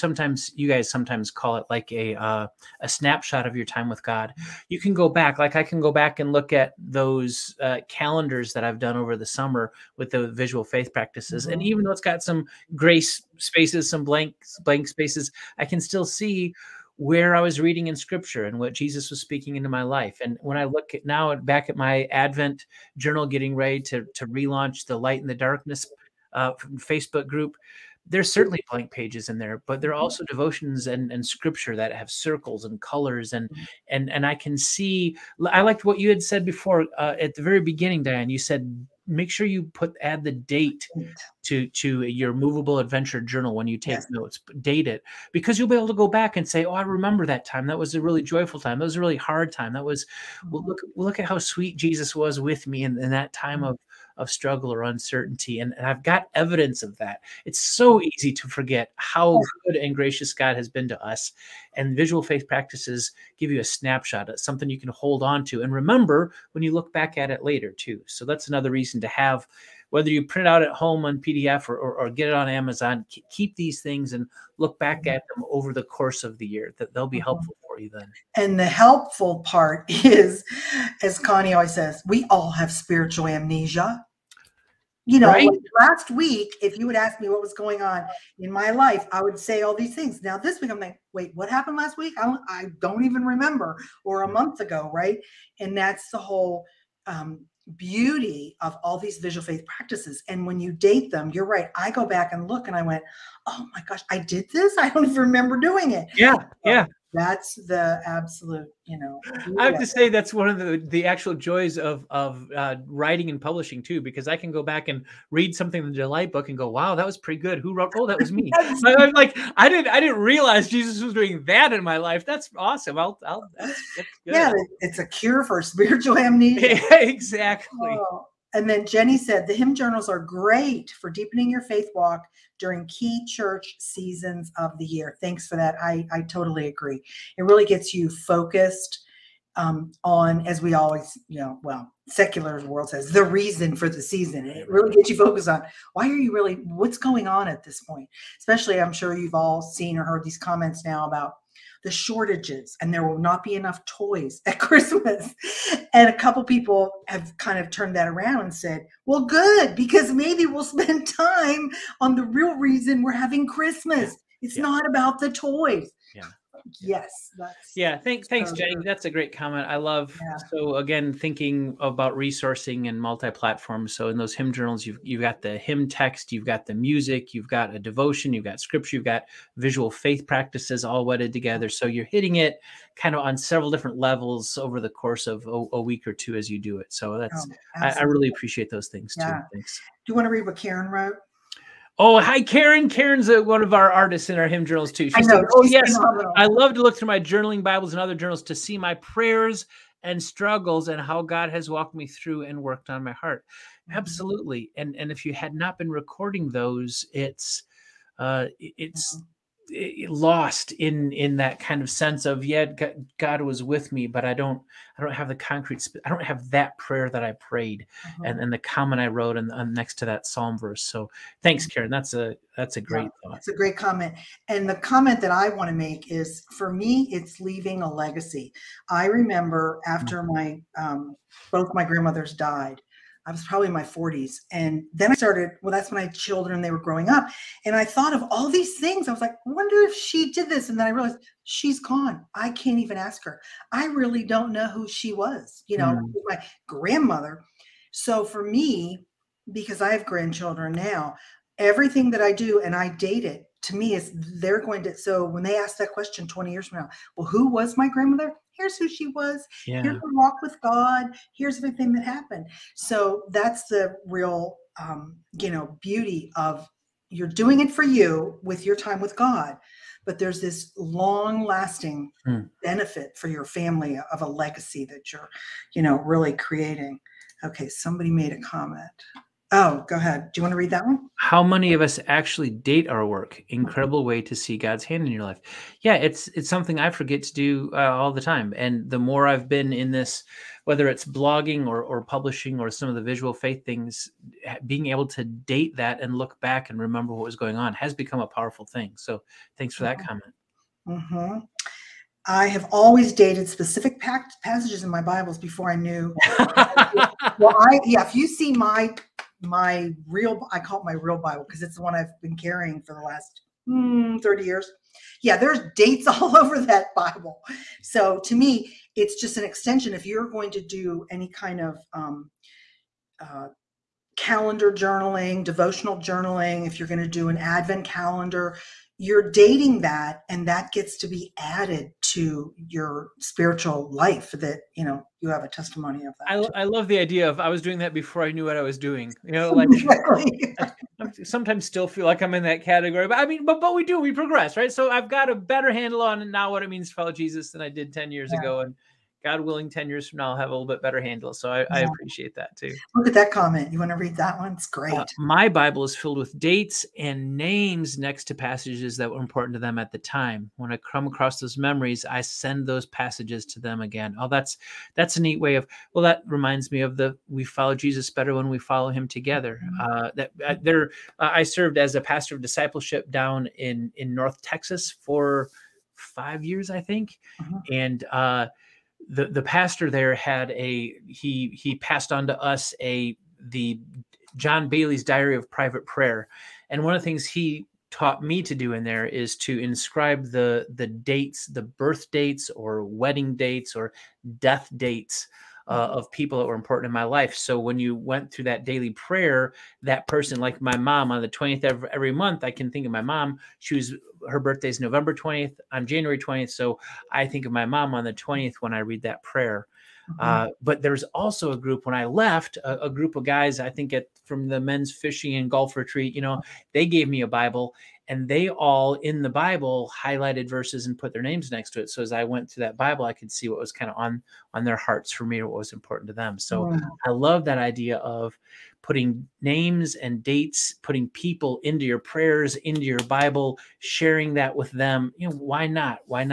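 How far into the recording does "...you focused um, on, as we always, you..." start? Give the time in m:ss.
2:17.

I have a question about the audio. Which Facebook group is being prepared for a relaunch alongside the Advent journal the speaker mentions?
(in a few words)
The light and the darkness.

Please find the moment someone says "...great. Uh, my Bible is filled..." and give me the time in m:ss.
5:54.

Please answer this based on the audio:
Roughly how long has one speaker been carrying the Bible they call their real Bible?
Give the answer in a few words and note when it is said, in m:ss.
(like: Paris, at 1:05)
30 years, at 5:14.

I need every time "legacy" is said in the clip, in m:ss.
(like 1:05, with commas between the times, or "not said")
3:47, 4:34.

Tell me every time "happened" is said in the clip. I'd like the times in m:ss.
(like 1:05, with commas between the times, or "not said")
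1:31, 4:22.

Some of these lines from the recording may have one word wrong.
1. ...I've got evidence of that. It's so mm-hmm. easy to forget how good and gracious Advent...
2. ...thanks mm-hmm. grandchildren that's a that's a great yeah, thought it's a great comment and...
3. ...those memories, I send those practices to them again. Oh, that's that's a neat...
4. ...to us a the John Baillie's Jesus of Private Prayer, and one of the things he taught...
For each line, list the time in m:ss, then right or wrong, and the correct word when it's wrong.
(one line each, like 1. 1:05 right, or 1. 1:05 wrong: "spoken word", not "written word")
1. 0:55 wrong: "God", not "Advent"
2. 3:41 wrong: "karen", not "grandchildren"
3. 6:01 wrong: "passages", not "practices"
4. 6:22 wrong: "Diary", not "Jesus".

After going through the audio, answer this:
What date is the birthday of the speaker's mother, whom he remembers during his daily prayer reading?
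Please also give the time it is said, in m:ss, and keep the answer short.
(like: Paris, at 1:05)
November 20, at 6:44.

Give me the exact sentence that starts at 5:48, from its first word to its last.
ago and God willing, 10 years from now, I'll have a little bit better handle.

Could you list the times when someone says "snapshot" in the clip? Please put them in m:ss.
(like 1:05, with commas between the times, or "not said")
0:02, 1:03.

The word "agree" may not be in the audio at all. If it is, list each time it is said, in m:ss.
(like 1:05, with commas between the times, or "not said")
2:16.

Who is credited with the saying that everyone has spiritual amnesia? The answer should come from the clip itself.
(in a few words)
Connie.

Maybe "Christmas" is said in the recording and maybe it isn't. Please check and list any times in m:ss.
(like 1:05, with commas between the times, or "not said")
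2:34, 2:43.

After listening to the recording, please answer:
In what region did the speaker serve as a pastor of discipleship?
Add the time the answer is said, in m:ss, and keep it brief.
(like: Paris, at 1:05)
North Texas, at 6:14.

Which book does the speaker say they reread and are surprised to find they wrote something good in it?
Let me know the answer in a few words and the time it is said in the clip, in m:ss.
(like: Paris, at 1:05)
The delight book, at 1:55.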